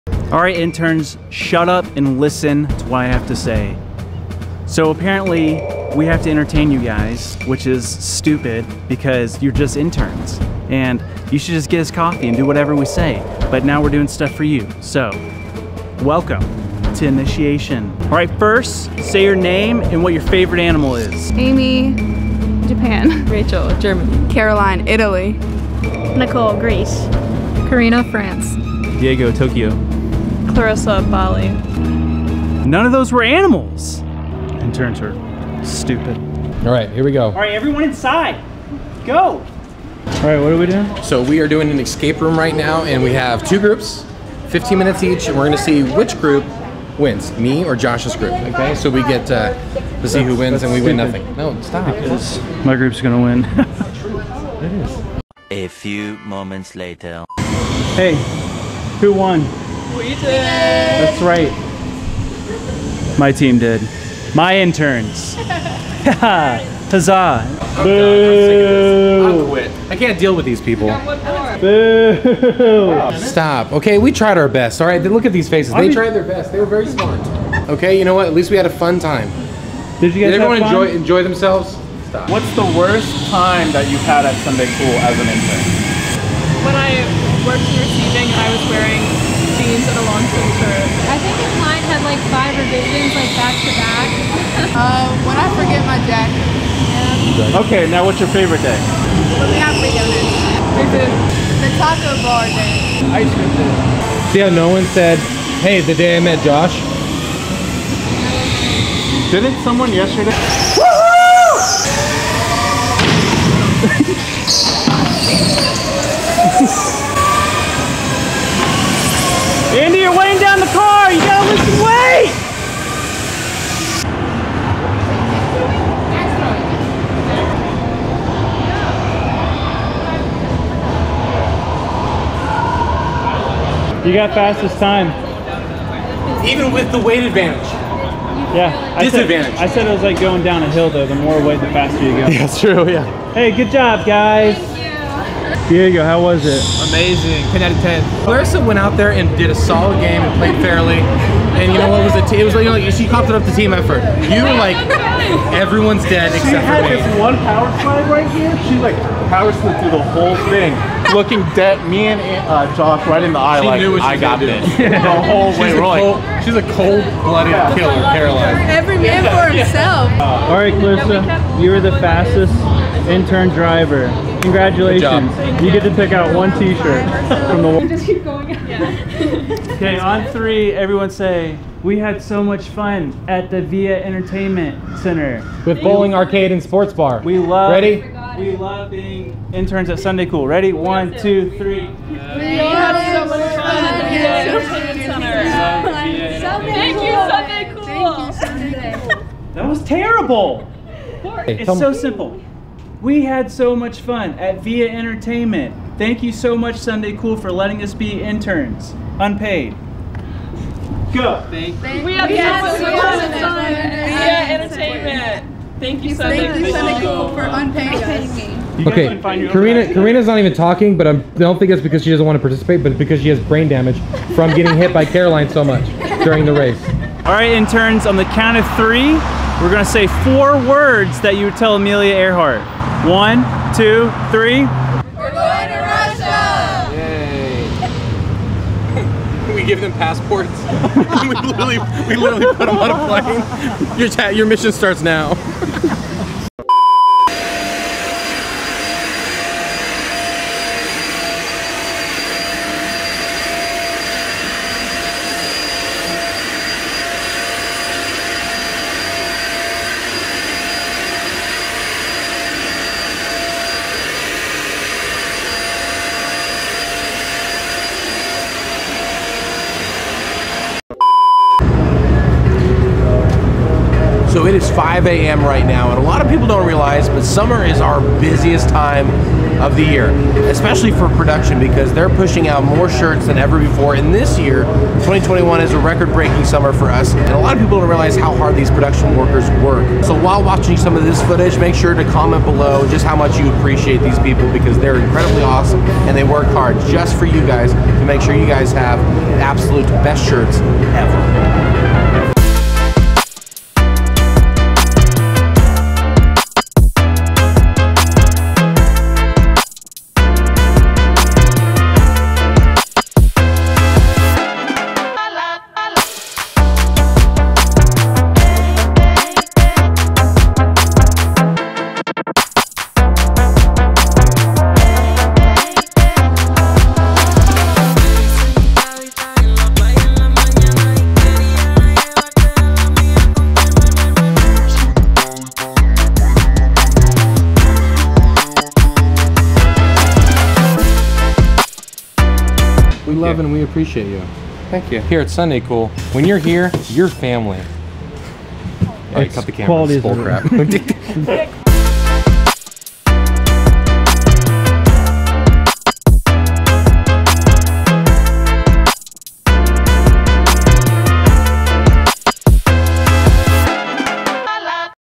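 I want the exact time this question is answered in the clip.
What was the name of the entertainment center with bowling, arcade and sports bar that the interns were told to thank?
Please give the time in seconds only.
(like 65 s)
183 s.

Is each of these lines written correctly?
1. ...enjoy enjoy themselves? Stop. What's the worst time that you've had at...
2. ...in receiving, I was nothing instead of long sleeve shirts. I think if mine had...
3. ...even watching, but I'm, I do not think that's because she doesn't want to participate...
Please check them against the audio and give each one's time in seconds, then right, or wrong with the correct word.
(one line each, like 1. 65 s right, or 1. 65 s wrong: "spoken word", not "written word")
1. 80 s right
2. 87 s wrong: "wearing", not "nothing"
3. 220 s wrong: "talking", not "watching".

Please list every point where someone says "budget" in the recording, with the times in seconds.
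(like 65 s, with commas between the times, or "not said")
not said.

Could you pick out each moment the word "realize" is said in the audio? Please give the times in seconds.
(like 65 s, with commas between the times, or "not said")
276 s, 287 s.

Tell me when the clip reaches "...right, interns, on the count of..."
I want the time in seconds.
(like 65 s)
227 s.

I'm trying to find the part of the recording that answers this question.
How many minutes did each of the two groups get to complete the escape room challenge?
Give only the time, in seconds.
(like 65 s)
44 s.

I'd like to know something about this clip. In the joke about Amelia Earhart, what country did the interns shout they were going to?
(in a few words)
Russia.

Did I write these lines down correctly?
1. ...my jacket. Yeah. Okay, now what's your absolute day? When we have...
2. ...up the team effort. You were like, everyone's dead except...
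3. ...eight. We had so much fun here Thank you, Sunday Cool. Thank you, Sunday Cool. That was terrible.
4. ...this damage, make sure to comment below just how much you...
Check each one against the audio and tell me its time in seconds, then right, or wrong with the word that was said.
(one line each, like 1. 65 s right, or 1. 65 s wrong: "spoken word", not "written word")
1. 95 s wrong: "favorite", not "absolute"
2. 153 s right
3. 191 s wrong: "three", not "eight"
4. 291 s wrong: "footage", not "damage".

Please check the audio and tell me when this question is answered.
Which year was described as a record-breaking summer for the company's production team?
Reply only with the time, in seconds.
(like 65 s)
285 s.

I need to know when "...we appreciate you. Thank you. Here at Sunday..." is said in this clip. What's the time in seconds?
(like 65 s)
343 s.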